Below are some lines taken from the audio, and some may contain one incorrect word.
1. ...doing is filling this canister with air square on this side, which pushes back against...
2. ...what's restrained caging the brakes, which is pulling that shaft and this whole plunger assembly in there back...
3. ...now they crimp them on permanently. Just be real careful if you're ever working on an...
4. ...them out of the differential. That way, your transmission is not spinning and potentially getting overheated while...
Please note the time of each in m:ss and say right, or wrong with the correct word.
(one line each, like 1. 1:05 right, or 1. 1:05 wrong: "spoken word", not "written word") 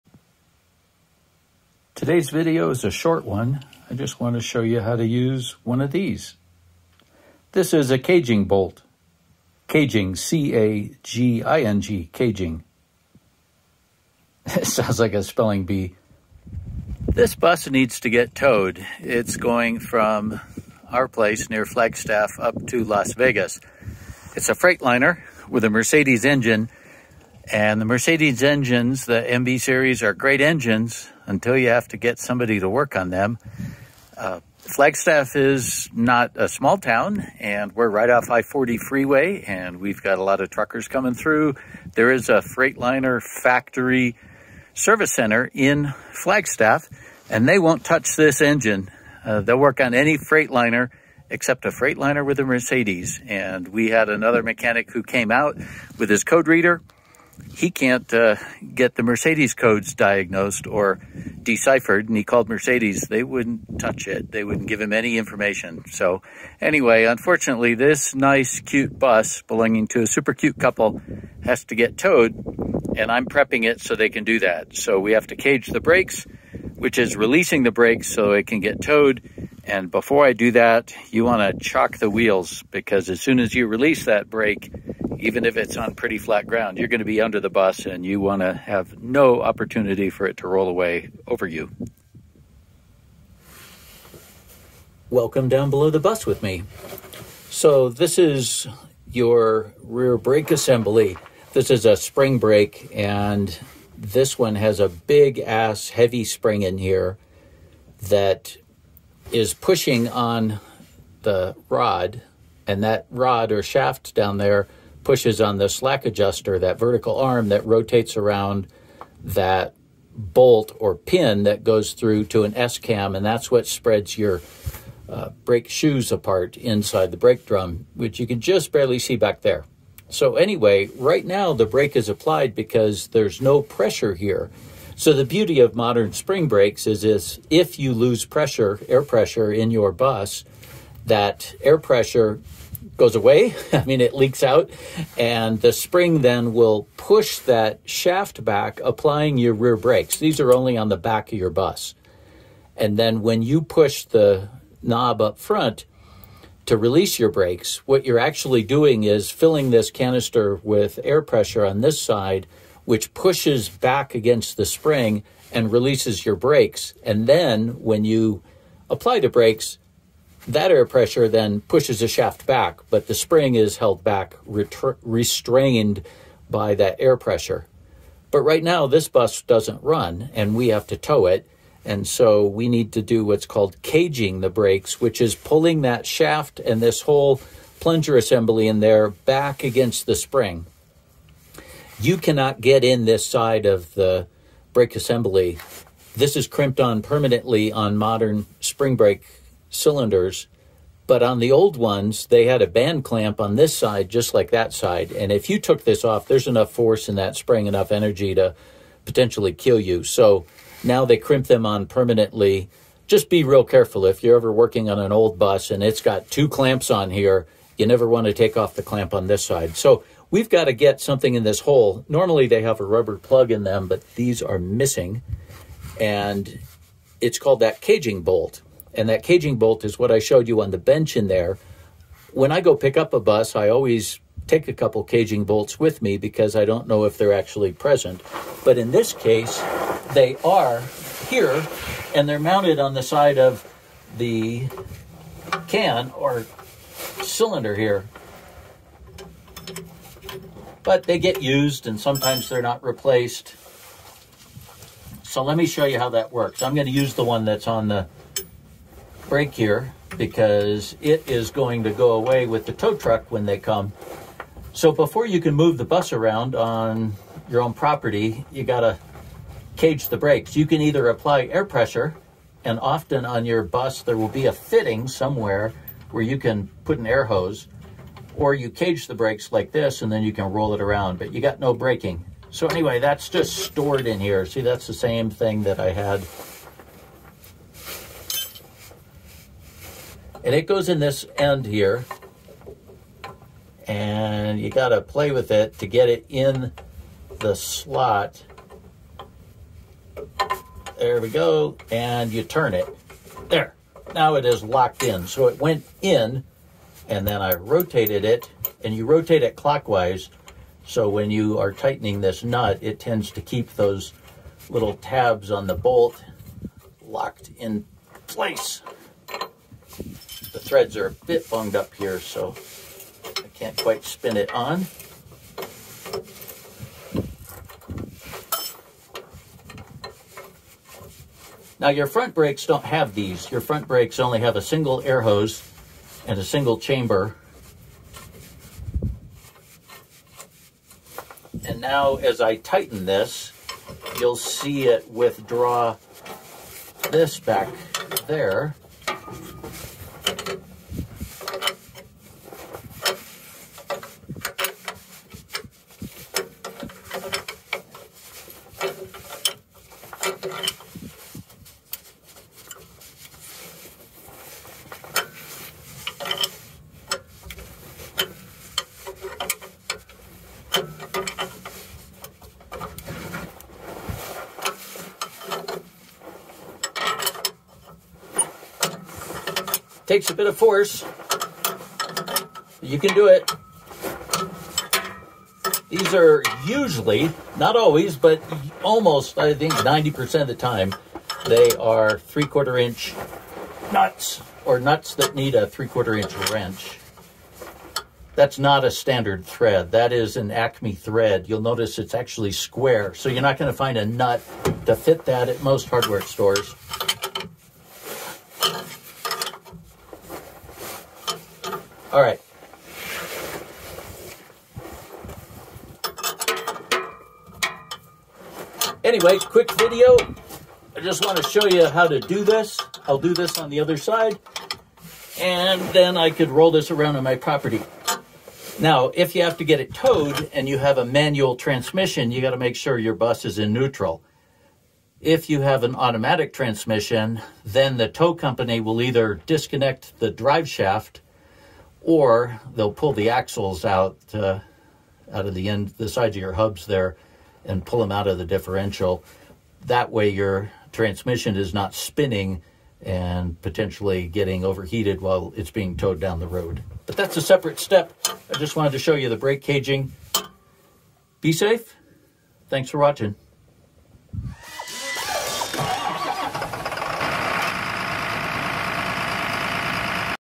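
1. 2:38 wrong: "pressure", not "square"
2. 3:03 wrong: "called", not "restrained"
3. 3:30 right
4. 7:27 right.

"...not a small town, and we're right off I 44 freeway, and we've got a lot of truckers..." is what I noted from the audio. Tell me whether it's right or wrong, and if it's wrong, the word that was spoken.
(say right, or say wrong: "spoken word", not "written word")
wrong: "40", not "44".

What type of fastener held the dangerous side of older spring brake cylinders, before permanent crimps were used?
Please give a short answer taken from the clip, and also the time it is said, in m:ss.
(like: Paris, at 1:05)
band clamp, at 3:22.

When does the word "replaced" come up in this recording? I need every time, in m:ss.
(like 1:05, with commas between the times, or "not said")
4:12.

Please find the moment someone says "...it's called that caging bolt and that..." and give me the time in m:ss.
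3:47.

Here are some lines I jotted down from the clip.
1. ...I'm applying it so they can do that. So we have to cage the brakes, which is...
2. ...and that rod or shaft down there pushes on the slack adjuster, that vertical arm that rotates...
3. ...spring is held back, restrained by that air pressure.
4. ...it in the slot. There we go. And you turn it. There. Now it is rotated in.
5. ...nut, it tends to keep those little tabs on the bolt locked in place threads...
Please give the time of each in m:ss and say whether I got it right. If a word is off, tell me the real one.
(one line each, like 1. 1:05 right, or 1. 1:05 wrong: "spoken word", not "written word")
1. 1:13 wrong: "prepping", not "applying"
2. 1:52 right
3. 2:53 right
4. 4:56 wrong: "locked", not "rotated"
5. 5:12 right.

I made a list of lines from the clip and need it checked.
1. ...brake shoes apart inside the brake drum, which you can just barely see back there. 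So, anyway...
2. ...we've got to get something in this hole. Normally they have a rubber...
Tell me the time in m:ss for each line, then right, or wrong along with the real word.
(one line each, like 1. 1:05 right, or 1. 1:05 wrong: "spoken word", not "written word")
1. 2:05 right
2. 3:40 right.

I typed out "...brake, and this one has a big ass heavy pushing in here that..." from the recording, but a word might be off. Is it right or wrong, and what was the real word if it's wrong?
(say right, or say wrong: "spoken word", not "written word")
wrong: "spring", not "pushing".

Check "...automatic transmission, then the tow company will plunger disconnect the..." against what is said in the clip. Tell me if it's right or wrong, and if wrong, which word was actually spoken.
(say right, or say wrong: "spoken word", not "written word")
wrong: "either", not "plunger".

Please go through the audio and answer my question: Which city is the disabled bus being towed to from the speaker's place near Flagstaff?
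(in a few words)
Las Vegas.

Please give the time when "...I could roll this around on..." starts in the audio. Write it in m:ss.
7:06.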